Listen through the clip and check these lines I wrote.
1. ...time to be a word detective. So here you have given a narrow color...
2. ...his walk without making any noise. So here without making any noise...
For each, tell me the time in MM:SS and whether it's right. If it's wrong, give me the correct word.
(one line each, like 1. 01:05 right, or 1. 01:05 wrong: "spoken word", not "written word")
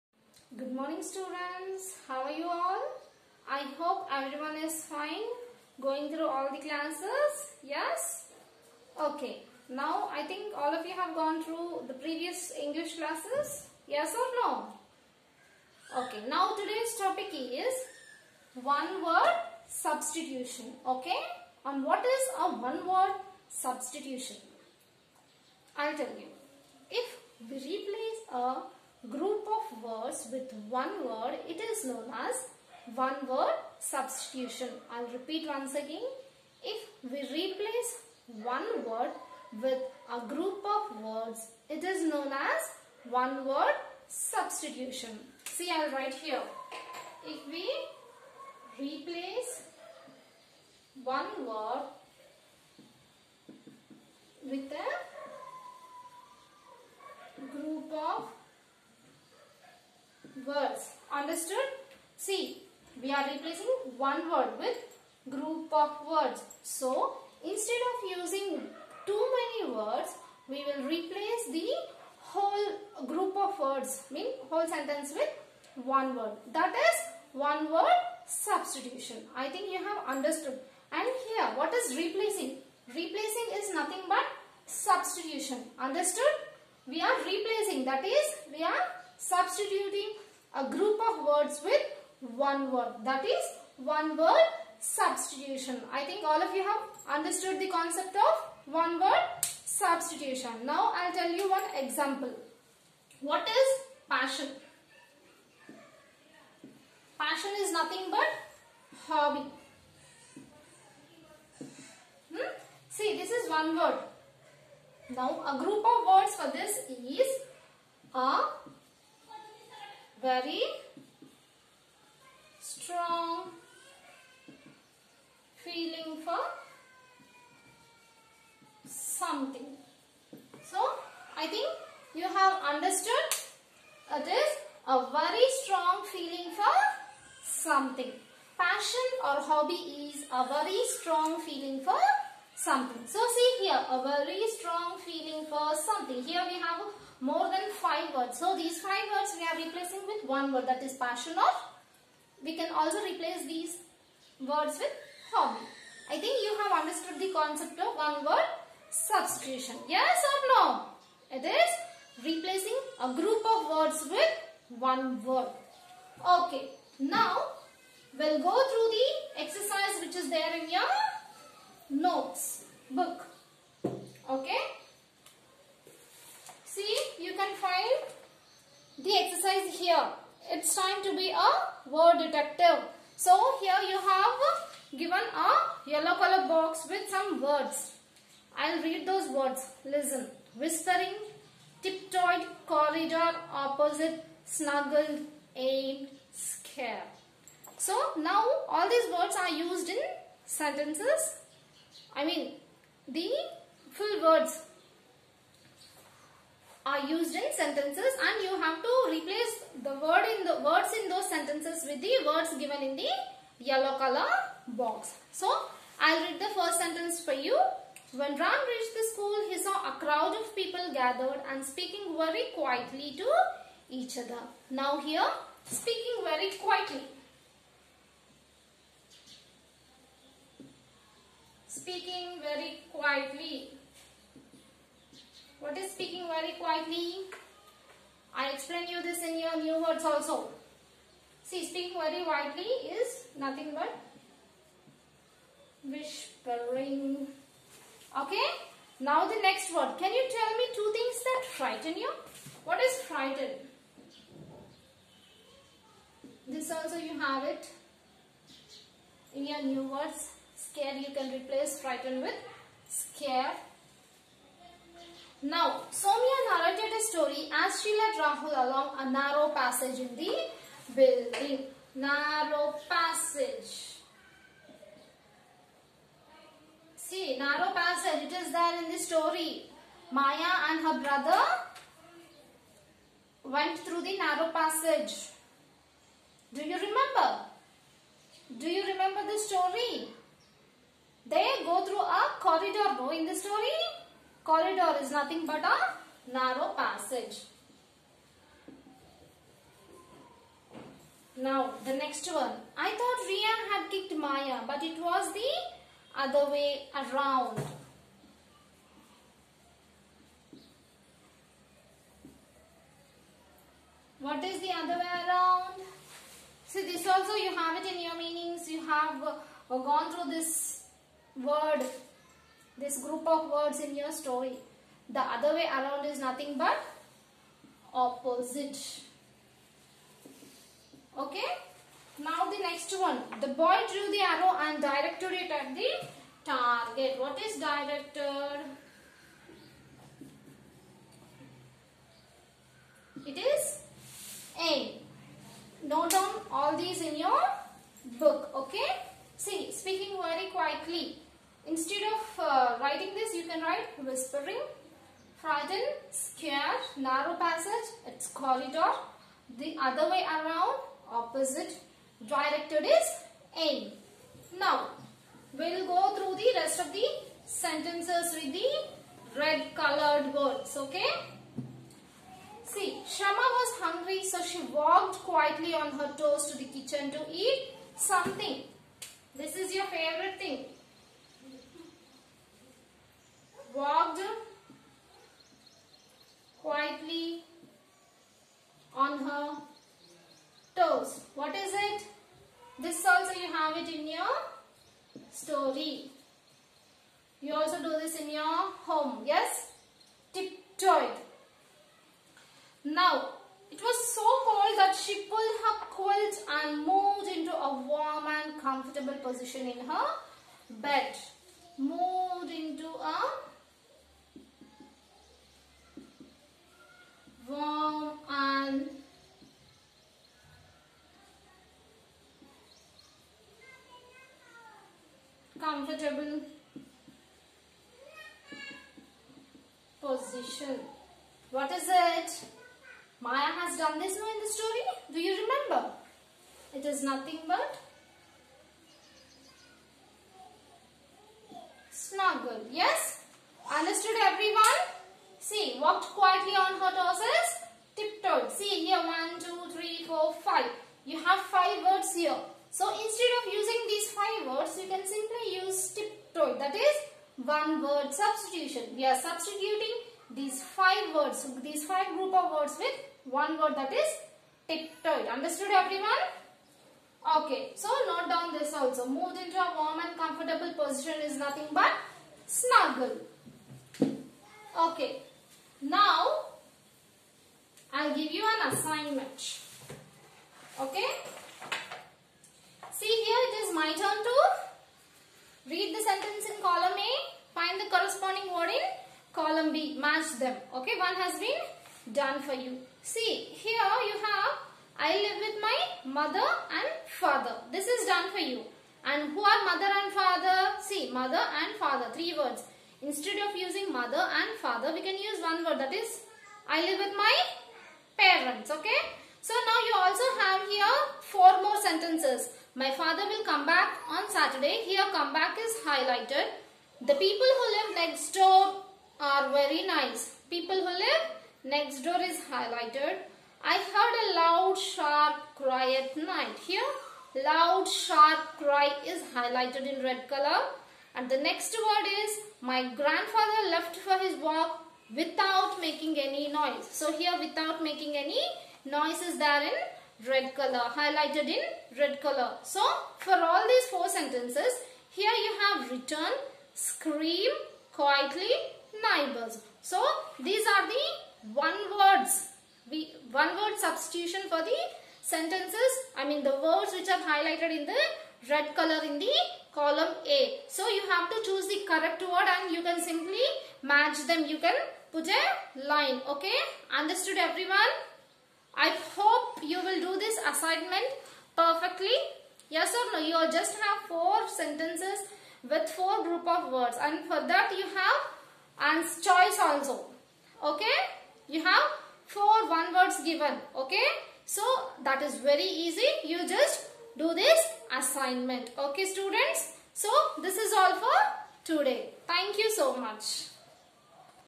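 1. 03:00 wrong: "yellow", not "narrow"
2. 08:54 right.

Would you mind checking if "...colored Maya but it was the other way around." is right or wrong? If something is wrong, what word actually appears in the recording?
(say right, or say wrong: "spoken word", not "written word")
wrong: "kicked", not "colored".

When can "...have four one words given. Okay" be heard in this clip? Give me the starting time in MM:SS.
09:41.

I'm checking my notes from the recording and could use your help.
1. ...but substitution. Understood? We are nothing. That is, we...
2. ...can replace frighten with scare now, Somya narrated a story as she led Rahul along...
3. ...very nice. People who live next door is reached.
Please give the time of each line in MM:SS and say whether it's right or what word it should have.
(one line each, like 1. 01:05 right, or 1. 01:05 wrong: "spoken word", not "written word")
1. 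01:24 wrong: "replacing", not "nothing"
2. 04:21 right
3. 08:39 wrong: "highlighted", not "reached".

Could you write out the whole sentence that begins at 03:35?
So I'll read the first sentence for you.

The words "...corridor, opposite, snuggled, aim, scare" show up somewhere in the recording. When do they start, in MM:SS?
03:12.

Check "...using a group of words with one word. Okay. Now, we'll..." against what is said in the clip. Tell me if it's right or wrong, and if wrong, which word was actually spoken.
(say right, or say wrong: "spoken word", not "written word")
wrong: "replacing", not "using".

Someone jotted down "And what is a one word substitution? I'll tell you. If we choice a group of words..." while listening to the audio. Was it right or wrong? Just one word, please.
wrong.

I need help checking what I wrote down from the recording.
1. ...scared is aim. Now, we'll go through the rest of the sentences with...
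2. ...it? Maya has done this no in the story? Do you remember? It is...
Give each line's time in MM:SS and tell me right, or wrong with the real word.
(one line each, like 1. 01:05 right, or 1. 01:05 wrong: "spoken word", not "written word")
1. 06:02 wrong: "directed", not "scared"
2. 07:11 right.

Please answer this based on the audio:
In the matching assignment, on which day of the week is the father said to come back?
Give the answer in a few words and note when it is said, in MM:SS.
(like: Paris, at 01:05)
Saturday, at 08:34.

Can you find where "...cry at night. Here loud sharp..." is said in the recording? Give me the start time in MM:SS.
08:45.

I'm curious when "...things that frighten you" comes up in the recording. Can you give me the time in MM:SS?
04:10.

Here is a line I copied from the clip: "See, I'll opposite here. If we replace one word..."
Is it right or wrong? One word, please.
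wrong.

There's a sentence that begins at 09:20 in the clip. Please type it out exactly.
So you have to choose the correct word and you can simply match them.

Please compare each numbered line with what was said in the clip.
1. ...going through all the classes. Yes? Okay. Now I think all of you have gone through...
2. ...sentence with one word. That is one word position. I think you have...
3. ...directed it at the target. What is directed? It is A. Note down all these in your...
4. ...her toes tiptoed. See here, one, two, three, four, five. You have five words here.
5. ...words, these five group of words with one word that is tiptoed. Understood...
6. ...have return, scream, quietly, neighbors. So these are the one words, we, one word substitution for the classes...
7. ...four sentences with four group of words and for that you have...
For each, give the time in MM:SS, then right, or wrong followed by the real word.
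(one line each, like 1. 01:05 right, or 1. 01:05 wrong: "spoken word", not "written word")
1. 00:05 right
2. 01:14 wrong: "substitution", not "position"
3. 05:34 right
4. 07:26 right
5. 07:41 right
6. 09:05 wrong: "sentences", not "classes"
7. 09:34 right.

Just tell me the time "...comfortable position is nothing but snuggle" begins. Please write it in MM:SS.
07:50.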